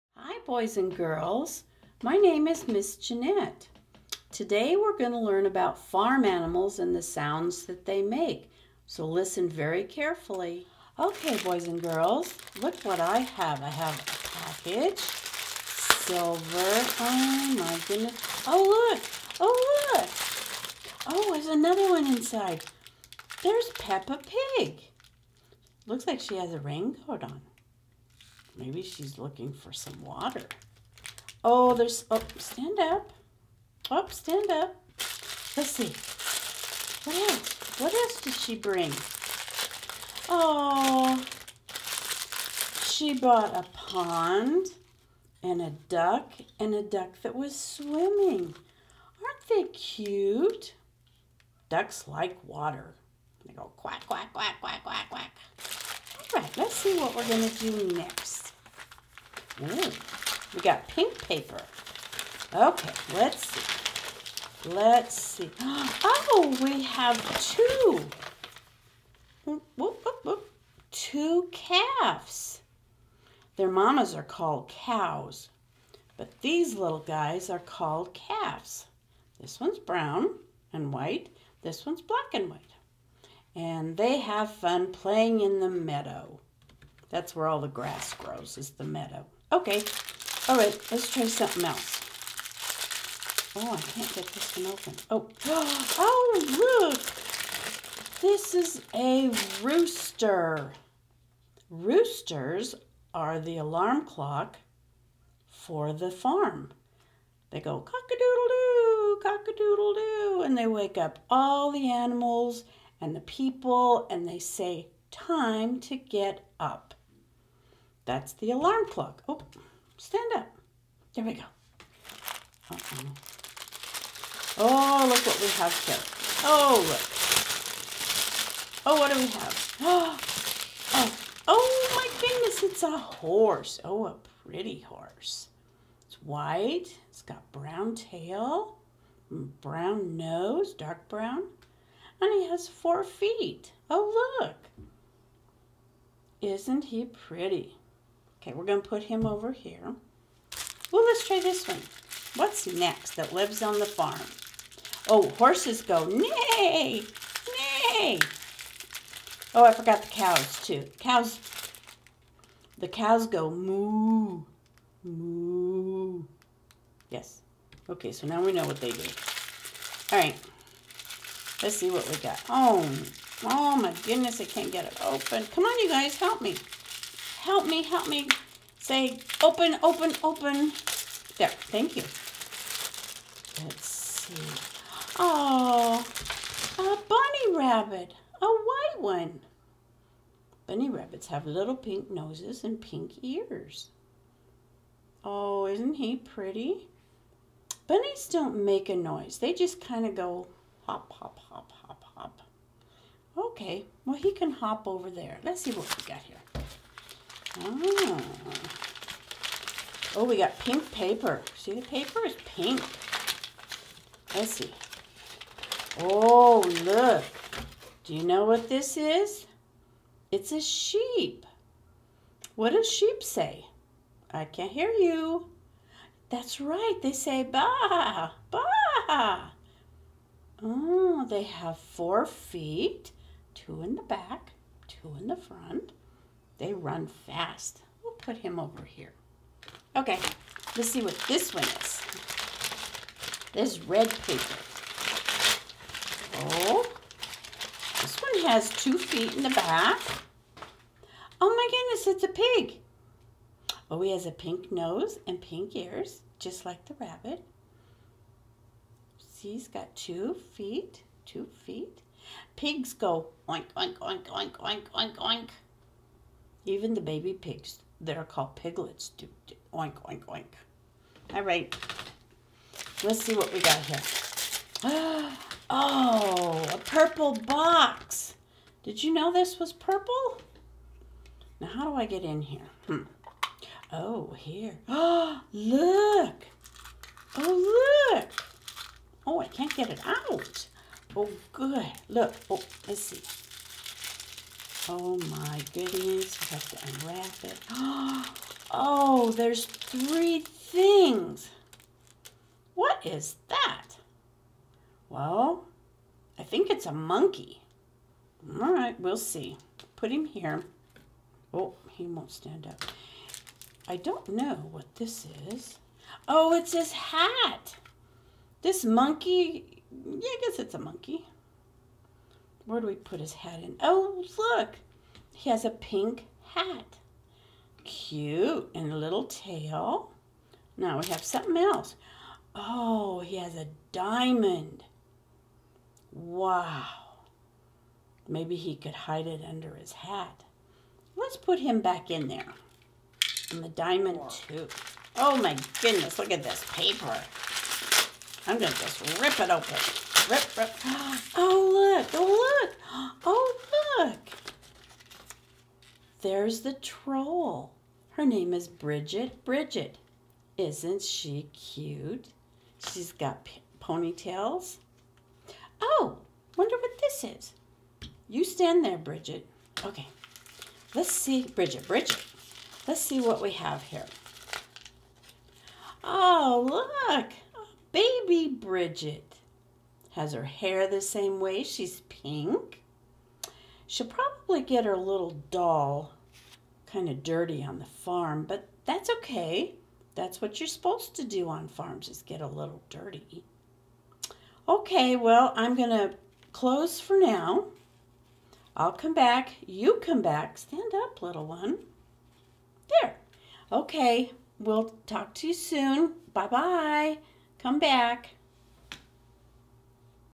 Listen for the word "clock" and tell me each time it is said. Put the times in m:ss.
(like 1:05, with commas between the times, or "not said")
1:44, 1:58.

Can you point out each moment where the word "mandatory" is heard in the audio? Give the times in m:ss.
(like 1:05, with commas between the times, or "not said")
not said.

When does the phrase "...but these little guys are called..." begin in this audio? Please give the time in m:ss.
1:16.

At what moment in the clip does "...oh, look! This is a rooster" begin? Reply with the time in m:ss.
1:35.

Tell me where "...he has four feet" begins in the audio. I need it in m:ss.
2:22.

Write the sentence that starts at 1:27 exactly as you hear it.
That's where all the grass grows, is the meadow.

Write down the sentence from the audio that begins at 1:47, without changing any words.
They go cock-a-doodle-doo, cock-a-doodle-doo, and they wake up all the animals and the people, and they say, Time to get up.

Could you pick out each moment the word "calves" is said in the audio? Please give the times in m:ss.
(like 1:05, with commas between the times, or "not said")
1:11, 1:18.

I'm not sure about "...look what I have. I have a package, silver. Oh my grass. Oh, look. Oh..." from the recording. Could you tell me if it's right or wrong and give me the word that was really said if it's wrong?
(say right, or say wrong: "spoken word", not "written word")
wrong: "goodness", not "grass".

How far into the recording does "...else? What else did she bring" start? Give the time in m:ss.
0:37.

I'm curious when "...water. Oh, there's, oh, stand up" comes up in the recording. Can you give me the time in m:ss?
0:30.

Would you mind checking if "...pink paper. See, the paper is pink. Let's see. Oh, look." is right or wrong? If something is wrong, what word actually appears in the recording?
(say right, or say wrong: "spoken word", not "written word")
right.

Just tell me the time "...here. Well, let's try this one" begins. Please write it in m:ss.
2:29.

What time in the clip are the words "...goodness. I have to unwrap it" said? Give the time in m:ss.
4:55.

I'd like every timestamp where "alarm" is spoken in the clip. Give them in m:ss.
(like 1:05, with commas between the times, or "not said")
1:43, 1:58.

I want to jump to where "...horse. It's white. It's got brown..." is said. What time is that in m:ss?
2:14.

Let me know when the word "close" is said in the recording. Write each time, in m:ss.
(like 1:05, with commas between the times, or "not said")
6:36.